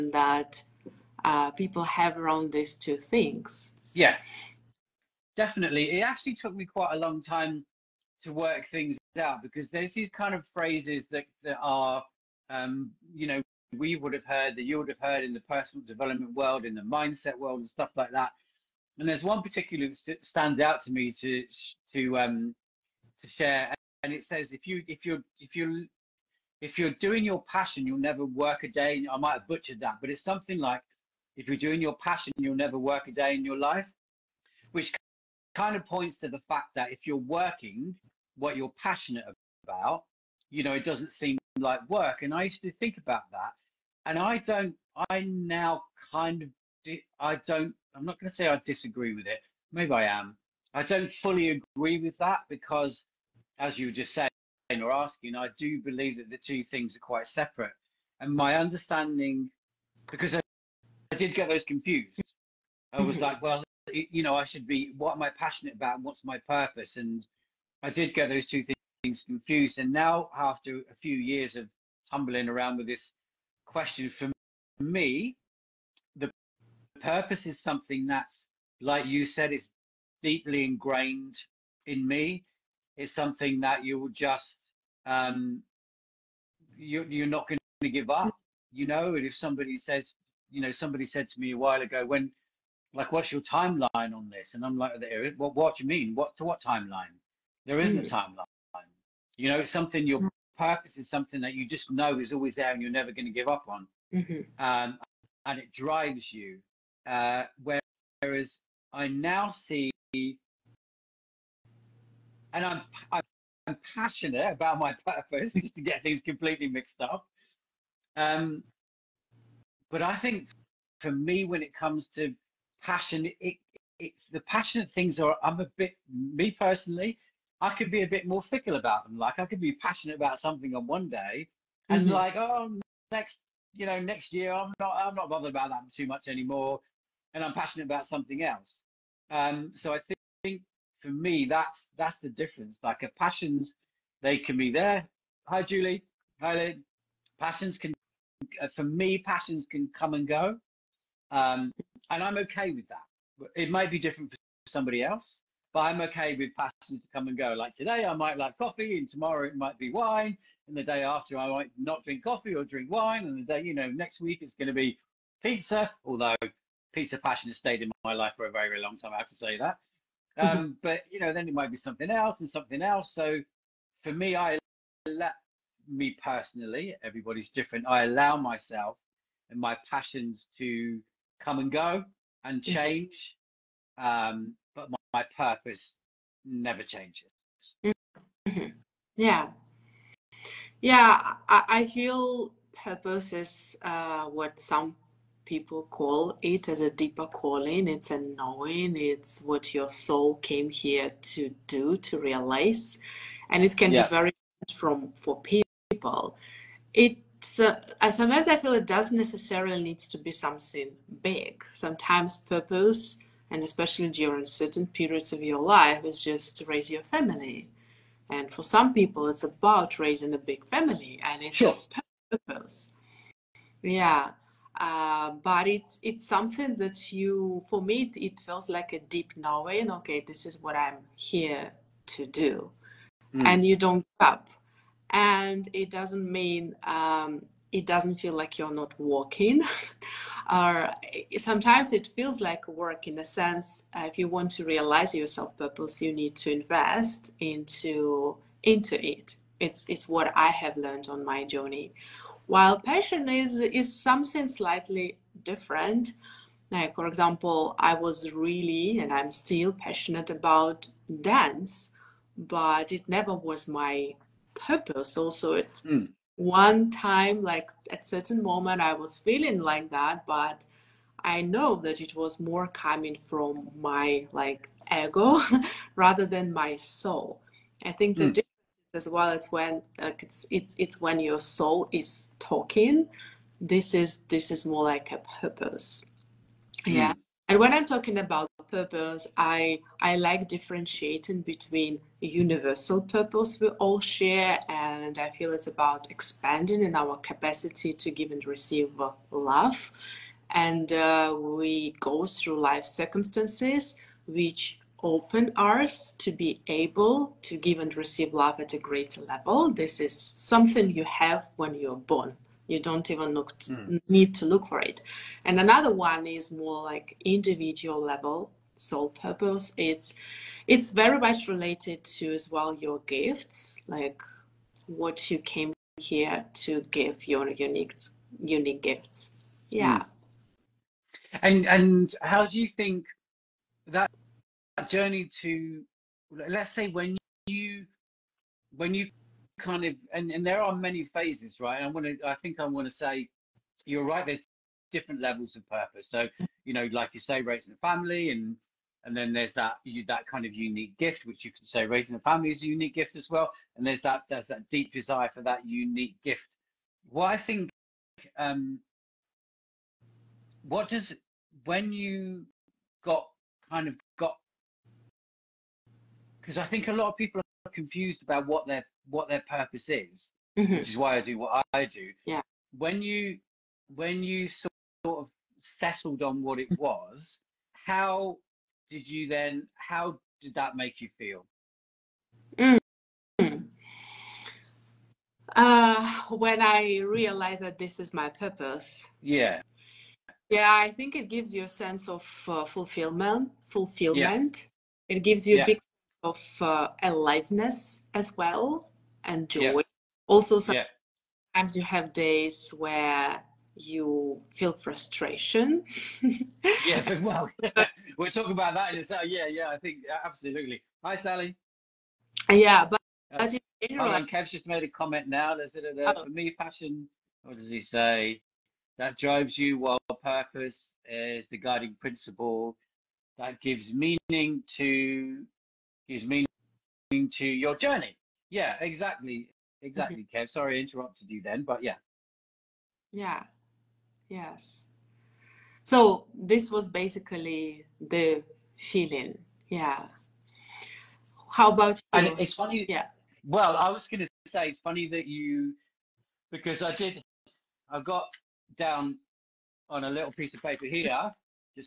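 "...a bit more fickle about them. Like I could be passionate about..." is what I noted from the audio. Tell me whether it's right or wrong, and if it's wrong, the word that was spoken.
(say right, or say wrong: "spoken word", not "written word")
right.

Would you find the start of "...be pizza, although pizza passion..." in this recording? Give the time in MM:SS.
02:44.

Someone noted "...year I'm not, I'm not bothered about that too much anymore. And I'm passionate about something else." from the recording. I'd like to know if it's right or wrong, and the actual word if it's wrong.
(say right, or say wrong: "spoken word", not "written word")
right.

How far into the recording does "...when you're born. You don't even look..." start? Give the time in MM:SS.
05:11.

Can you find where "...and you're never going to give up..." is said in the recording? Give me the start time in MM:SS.
01:42.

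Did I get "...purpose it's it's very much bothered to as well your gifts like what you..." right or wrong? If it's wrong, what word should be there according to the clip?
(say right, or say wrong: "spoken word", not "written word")
wrong: "related", not "bothered".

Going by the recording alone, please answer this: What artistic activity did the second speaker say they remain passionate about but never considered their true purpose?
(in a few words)
dance.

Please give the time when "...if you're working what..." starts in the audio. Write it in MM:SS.
00:36.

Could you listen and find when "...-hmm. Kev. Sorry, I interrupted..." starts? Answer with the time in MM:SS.
07:10.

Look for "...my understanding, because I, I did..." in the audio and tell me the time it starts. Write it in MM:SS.
00:58.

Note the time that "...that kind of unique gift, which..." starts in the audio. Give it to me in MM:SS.
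05:50.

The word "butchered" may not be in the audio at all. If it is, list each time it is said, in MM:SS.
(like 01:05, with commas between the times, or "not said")
00:29.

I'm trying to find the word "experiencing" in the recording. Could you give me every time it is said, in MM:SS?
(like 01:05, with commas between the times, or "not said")
not said.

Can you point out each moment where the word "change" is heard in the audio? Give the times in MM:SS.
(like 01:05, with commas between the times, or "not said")
03:02, 03:06.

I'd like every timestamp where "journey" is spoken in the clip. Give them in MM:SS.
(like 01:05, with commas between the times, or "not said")
04:11, 05:34, 07:07.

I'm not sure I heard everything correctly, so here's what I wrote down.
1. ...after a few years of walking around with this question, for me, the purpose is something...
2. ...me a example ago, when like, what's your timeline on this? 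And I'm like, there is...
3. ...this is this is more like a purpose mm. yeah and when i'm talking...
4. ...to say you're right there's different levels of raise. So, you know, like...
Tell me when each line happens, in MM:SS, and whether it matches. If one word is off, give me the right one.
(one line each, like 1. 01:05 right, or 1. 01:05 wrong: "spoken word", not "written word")
1. 01:10 wrong: "tumbling", not "walking"
2. 01:31 wrong: "while", not "example"
3. 04:43 right
4. 05:42 wrong: "purpose", not "raise".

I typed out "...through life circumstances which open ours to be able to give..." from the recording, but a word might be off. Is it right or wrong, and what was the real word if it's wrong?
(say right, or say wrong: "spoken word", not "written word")
right.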